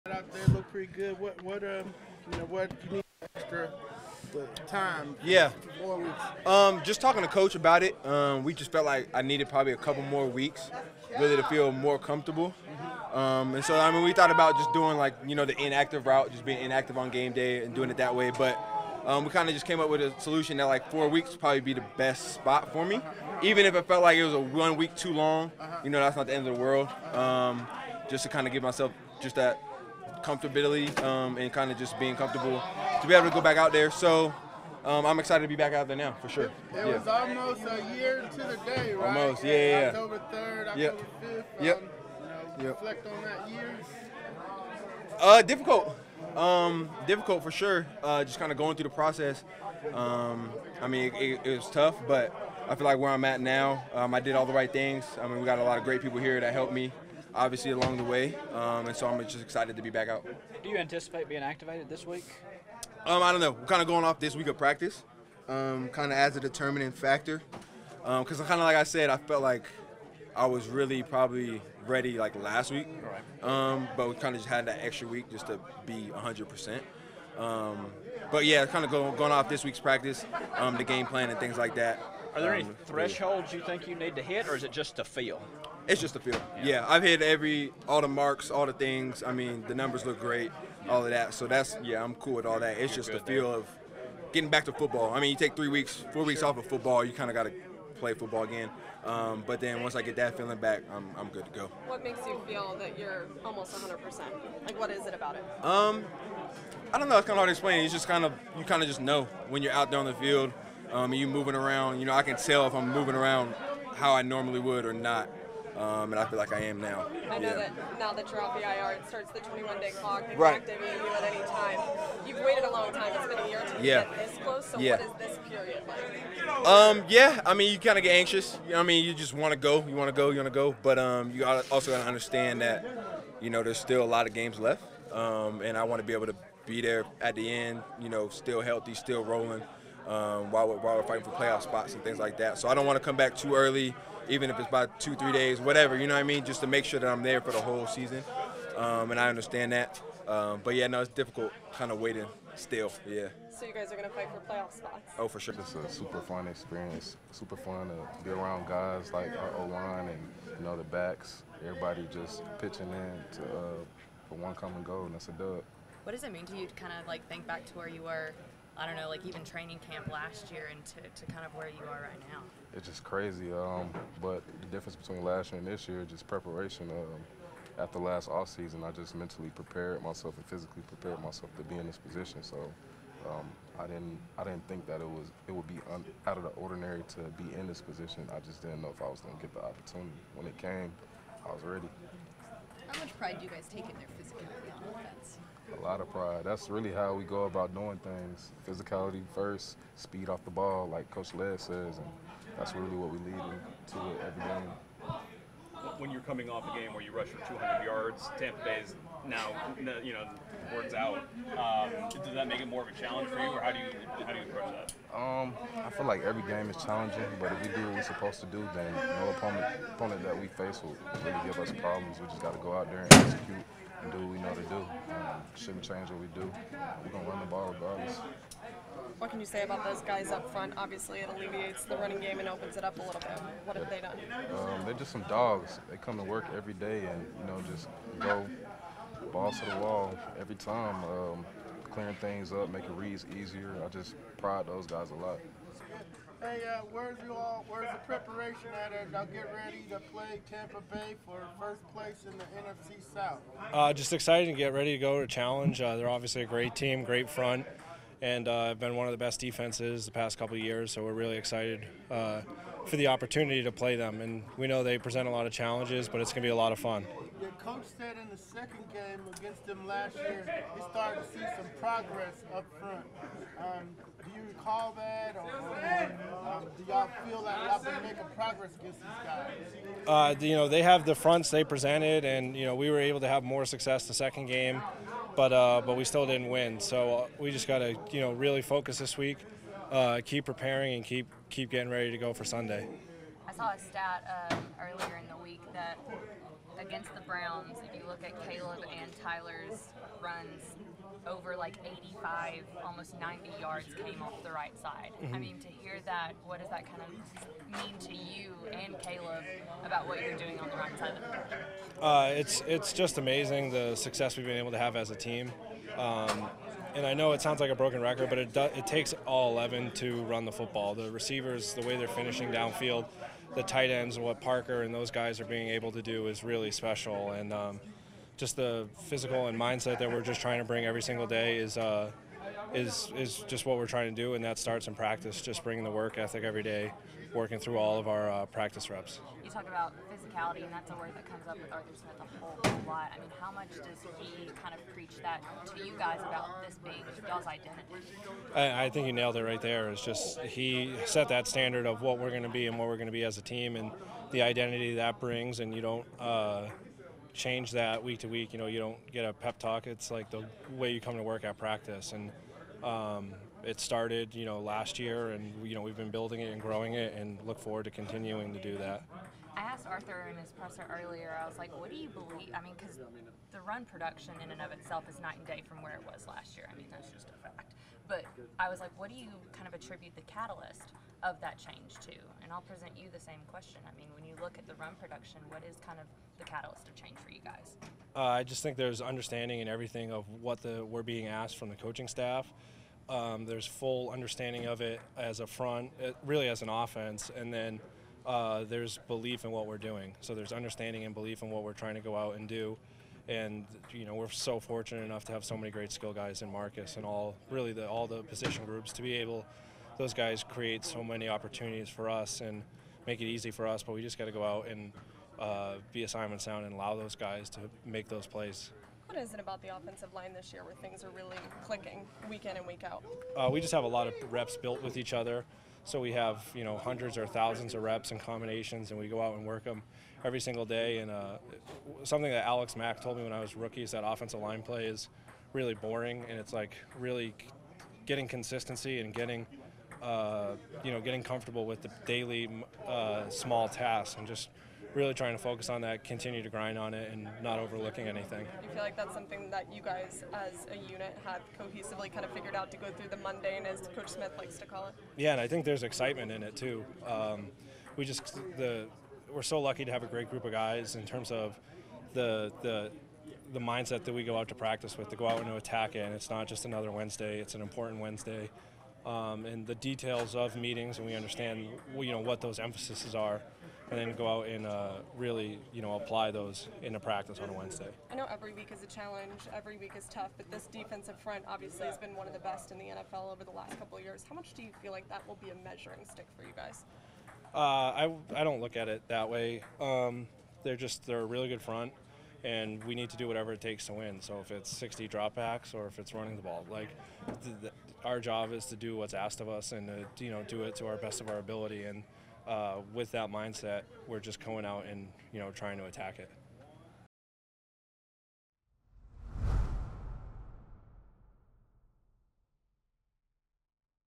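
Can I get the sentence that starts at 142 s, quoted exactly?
So I don't want to come back too early, even if it's by two, three days, whatever, you know what I mean?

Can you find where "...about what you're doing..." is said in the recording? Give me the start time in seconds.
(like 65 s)
309 s.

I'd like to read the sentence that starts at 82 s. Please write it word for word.
Are there any thresholds you think you need to hit, or is it just to feel?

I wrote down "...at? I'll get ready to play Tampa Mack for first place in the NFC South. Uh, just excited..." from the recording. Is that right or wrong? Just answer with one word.
wrong.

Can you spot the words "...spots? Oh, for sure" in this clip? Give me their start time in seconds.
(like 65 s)
154 s.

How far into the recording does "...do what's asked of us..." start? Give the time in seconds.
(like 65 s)
498 s.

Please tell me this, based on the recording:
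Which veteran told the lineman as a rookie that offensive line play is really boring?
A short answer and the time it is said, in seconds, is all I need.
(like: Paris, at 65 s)
Alex Mack, at 432 s.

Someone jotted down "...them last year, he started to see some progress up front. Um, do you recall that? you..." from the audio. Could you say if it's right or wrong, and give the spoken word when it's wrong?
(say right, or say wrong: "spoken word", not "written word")
right.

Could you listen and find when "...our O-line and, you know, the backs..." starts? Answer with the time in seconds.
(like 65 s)
159 s.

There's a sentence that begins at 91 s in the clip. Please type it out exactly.
So that's yeah, I'm cool with all that.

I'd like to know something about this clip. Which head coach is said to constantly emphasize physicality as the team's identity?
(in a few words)
Arthur Smith.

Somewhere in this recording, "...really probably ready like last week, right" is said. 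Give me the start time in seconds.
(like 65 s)
70 s.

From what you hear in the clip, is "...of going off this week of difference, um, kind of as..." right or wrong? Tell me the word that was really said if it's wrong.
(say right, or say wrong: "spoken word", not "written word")
wrong: "practice", not "difference".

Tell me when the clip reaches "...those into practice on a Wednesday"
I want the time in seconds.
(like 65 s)
476 s.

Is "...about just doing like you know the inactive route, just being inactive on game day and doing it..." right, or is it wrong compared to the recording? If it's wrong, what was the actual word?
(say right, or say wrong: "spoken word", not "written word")
right.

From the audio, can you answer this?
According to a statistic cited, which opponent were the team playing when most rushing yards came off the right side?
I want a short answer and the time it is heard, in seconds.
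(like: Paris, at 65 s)
Browns, at 297 s.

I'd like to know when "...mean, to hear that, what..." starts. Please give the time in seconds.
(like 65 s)
305 s.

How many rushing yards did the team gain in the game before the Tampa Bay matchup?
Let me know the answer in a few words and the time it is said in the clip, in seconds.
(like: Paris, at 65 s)
200, at 207 s.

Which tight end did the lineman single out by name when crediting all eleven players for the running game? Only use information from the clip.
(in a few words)
Parker.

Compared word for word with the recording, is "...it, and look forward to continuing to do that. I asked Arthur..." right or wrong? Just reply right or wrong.
right.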